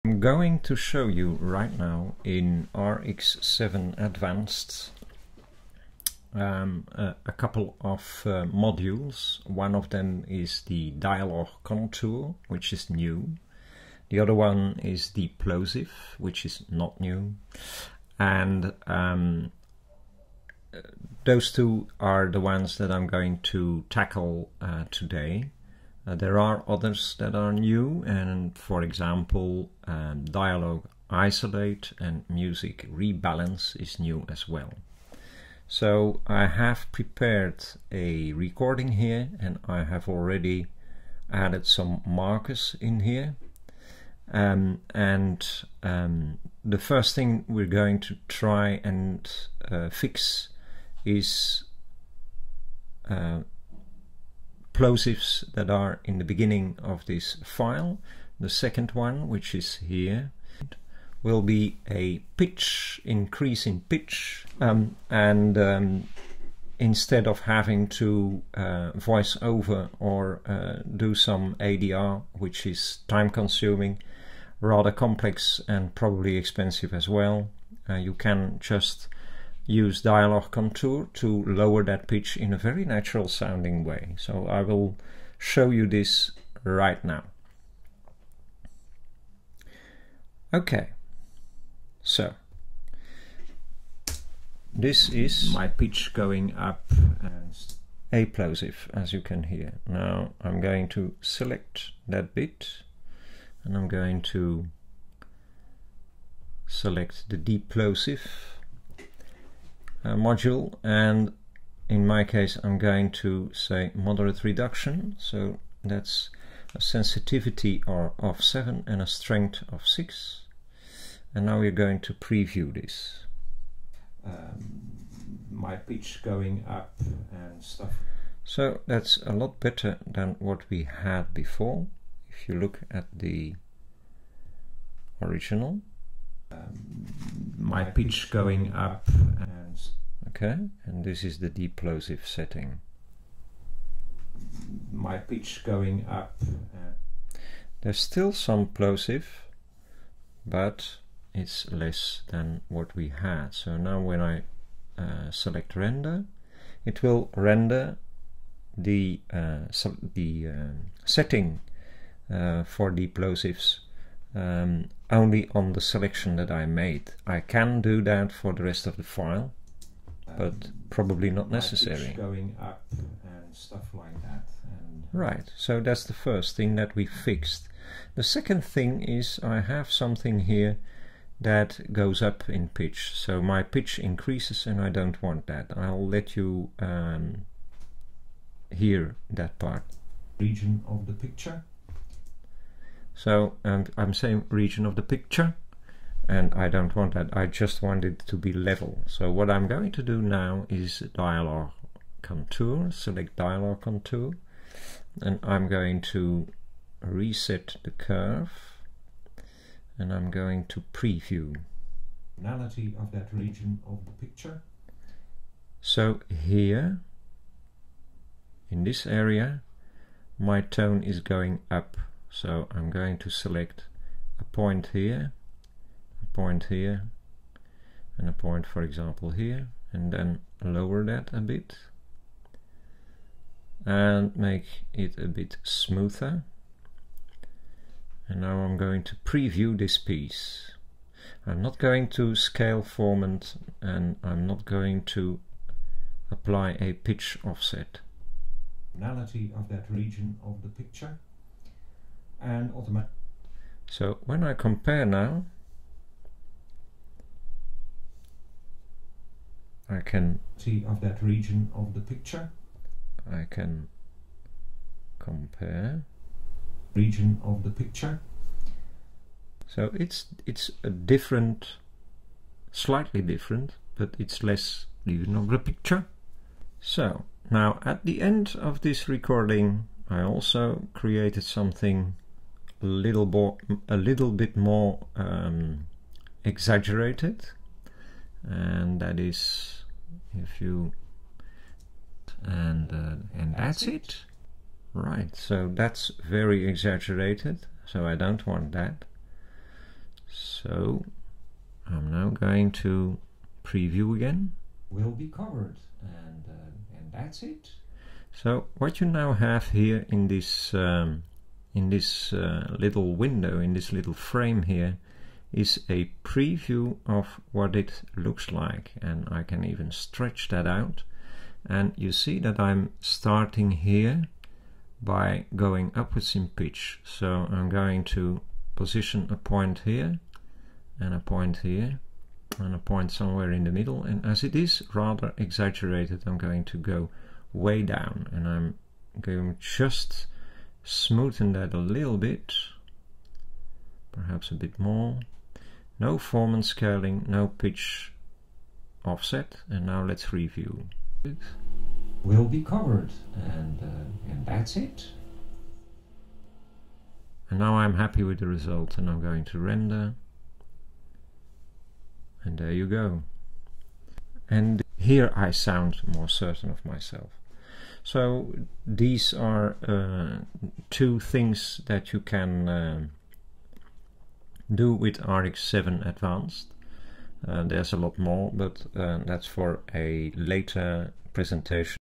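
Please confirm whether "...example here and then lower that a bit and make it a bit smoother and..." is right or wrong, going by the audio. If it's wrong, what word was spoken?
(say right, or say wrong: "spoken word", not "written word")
right.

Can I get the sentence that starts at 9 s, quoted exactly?
One of them is the dialogue contour, which is new.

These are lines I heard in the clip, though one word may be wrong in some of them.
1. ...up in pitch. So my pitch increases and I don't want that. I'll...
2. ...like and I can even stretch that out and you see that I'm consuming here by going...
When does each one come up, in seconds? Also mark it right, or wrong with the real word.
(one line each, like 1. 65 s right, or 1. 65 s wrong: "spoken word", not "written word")
1. 182 s right
2. 318 s wrong: "starting", not "consuming".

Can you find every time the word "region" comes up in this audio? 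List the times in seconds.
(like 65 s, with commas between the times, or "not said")
190 s, 194 s, 213 s, 249 s, 261 s, 266 s, 275 s.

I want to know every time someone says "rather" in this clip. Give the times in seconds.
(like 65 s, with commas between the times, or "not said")
74 s, 334 s.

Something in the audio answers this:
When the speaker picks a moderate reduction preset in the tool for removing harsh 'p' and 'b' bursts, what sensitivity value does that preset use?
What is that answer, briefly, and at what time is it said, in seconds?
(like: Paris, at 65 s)
7, at 116 s.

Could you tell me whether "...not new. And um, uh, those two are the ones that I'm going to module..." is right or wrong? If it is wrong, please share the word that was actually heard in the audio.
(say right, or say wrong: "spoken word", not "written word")
wrong: "tackle", not "module".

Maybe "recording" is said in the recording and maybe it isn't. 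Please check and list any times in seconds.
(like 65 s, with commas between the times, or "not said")
38 s, 279 s.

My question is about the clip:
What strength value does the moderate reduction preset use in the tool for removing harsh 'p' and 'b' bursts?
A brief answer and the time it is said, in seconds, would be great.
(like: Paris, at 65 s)
6, at 119 s.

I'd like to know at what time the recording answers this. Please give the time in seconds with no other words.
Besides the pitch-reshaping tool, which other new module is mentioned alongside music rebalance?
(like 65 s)
30 s.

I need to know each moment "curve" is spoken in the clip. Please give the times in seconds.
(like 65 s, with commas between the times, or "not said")
207 s.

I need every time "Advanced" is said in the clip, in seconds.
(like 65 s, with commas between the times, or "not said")
3 s, 376 s.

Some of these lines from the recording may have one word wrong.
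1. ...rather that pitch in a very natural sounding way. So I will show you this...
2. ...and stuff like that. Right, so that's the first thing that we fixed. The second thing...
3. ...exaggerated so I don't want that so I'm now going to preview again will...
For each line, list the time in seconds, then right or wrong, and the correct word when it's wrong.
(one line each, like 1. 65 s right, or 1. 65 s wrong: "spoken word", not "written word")
1. 81 s wrong: "lower", not "rather"
2. 172 s right
3. 296 s right.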